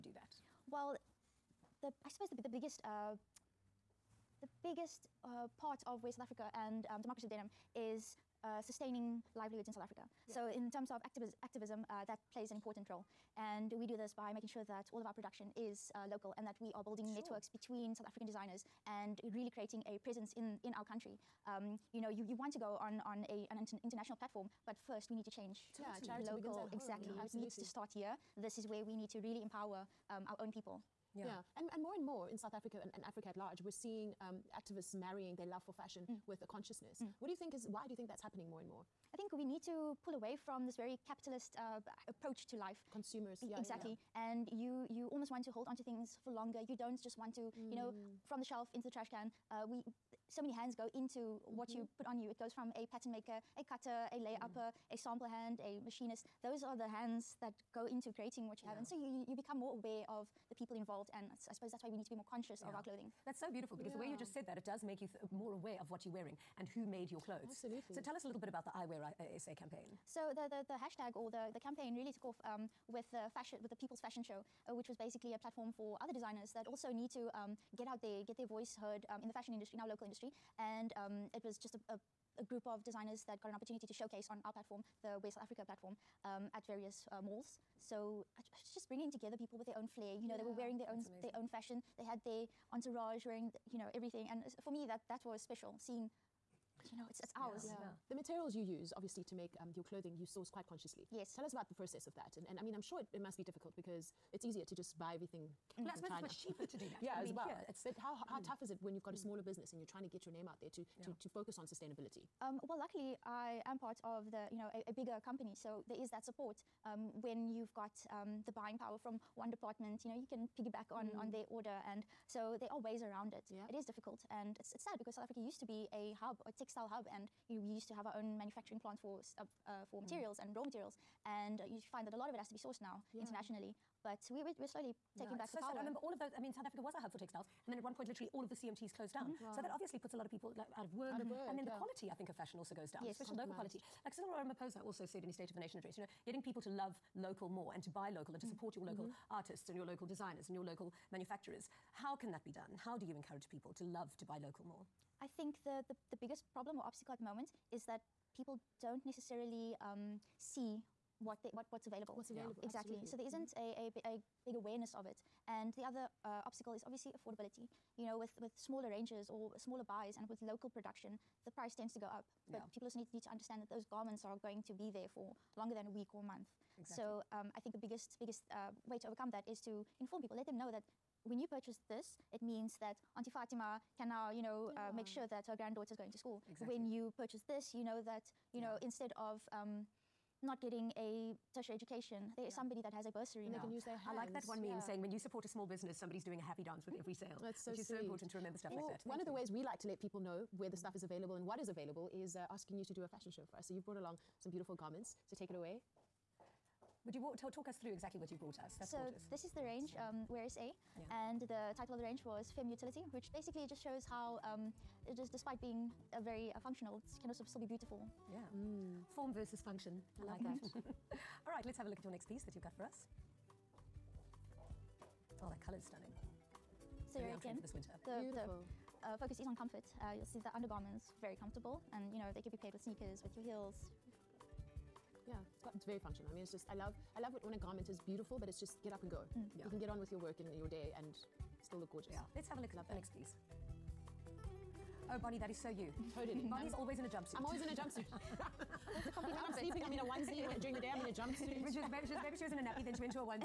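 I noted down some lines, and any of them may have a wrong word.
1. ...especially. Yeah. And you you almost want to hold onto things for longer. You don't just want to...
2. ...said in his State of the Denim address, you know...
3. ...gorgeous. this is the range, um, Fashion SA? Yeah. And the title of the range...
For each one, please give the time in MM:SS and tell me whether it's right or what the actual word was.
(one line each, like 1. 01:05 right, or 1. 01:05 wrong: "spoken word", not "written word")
1. 00:43 wrong: "exactly", not "especially"
2. 02:25 wrong: "Nation", not "Denim"
3. 03:28 wrong: "Wear", not "Fashion".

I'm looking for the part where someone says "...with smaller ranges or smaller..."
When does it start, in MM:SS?
02:48.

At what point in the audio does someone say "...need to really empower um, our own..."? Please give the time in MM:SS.
00:28.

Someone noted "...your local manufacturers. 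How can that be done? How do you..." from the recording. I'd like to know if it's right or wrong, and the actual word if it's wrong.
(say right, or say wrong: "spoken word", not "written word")
right.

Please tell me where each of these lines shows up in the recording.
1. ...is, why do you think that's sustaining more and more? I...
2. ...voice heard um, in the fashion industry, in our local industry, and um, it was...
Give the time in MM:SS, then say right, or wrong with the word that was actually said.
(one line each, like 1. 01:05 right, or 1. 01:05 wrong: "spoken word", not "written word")
1. 00:37 wrong: "happening", not "sustaining"
2. 01:18 right.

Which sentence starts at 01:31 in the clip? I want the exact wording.
They had their entourage wearing, you know, everything.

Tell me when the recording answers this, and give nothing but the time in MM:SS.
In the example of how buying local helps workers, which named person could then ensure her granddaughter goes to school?
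03:03.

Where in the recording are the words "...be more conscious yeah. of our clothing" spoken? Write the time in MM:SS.
01:02.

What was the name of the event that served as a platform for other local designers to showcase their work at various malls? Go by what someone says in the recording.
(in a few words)
People's Fashion Show.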